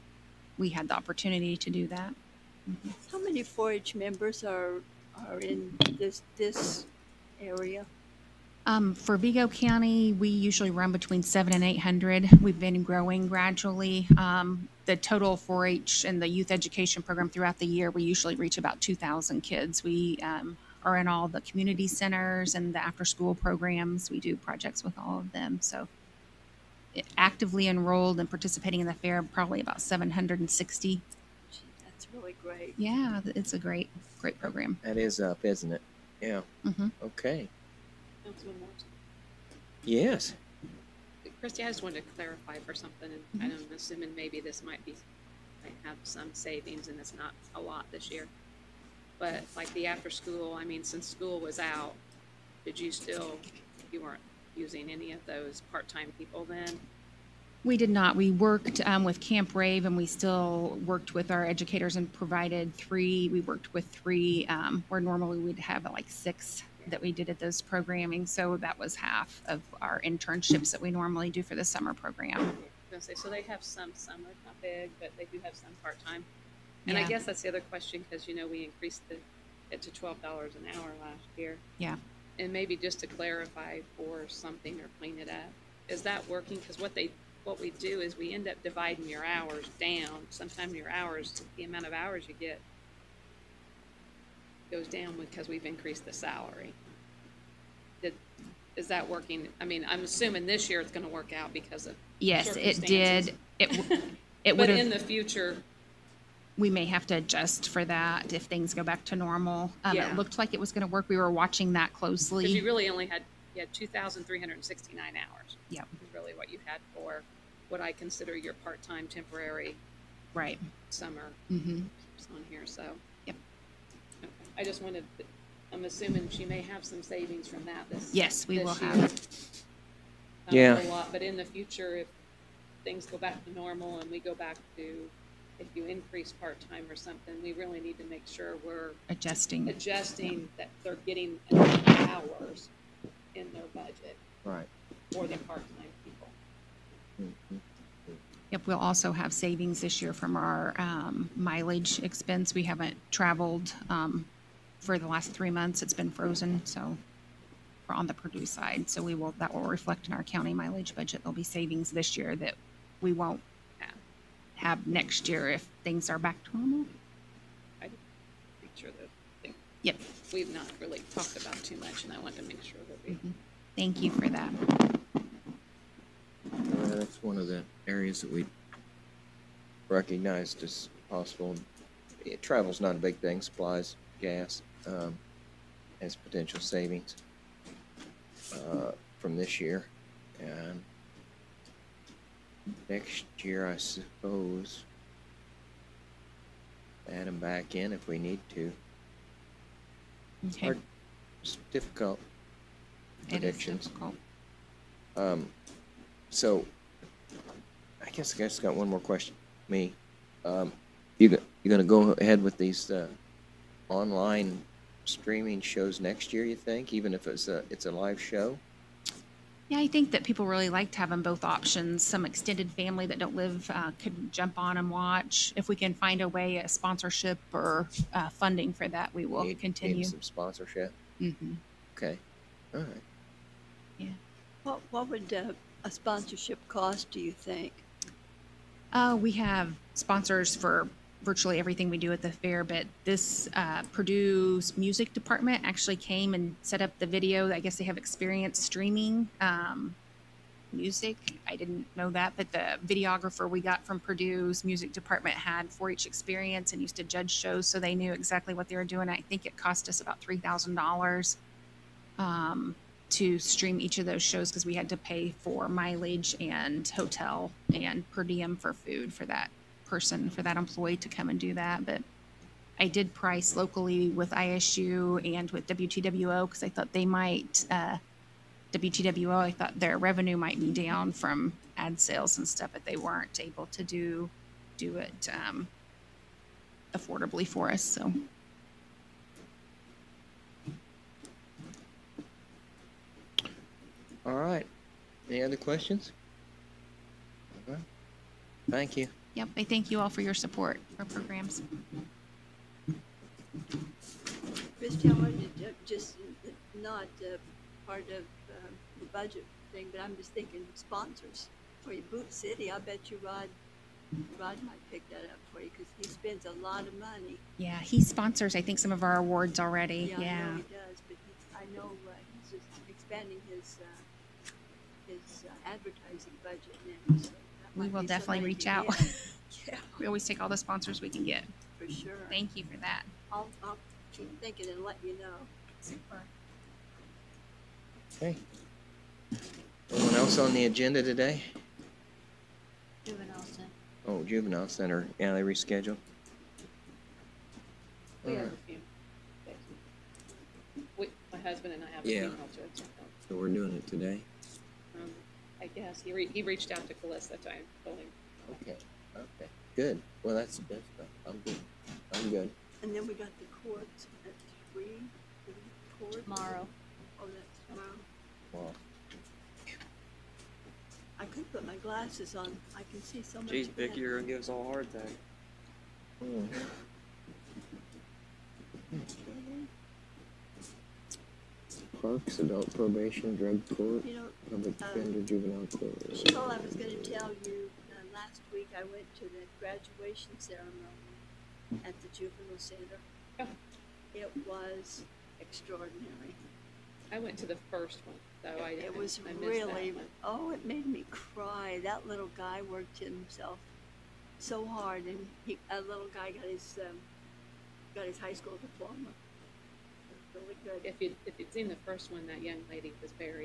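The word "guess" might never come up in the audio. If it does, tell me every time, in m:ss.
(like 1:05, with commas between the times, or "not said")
1:17, 3:28, 4:07, 5:55.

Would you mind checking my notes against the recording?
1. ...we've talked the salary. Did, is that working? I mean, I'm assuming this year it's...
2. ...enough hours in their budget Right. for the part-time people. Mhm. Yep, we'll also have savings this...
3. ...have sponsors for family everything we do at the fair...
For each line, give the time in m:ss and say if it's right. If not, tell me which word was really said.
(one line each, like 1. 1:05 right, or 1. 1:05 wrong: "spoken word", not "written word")
1. 1:35 wrong: "increased", not "talked"
2. 2:21 right
3. 3:59 wrong: "virtually", not "family".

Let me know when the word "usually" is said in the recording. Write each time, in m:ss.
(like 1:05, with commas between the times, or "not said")
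0:10, 0:18.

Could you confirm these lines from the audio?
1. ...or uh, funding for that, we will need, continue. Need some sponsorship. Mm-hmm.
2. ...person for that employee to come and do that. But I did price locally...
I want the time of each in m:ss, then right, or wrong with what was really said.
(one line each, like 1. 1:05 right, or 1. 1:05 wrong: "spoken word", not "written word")
1. 3:47 right
2. 4:29 right.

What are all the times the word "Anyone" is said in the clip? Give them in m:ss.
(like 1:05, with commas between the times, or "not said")
5:39.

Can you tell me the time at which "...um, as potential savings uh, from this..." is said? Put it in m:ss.
3:04.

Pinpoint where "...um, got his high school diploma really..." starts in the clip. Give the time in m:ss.
6:46.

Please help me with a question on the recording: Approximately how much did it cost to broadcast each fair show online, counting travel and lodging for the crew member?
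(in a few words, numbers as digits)
$3,000.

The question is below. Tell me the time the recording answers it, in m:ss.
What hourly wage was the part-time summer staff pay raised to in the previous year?
1:19.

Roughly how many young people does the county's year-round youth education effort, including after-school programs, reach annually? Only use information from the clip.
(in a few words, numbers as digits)
2,000.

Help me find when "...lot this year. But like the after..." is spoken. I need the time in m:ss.
0:47.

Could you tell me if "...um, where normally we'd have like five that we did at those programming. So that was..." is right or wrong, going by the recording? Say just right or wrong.
wrong.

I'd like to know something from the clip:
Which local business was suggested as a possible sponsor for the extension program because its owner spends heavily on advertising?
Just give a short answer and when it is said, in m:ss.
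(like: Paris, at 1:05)
Boot City, at 5:12.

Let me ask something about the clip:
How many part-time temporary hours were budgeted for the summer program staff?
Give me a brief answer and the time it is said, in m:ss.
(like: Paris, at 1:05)
2,369, at 1:53.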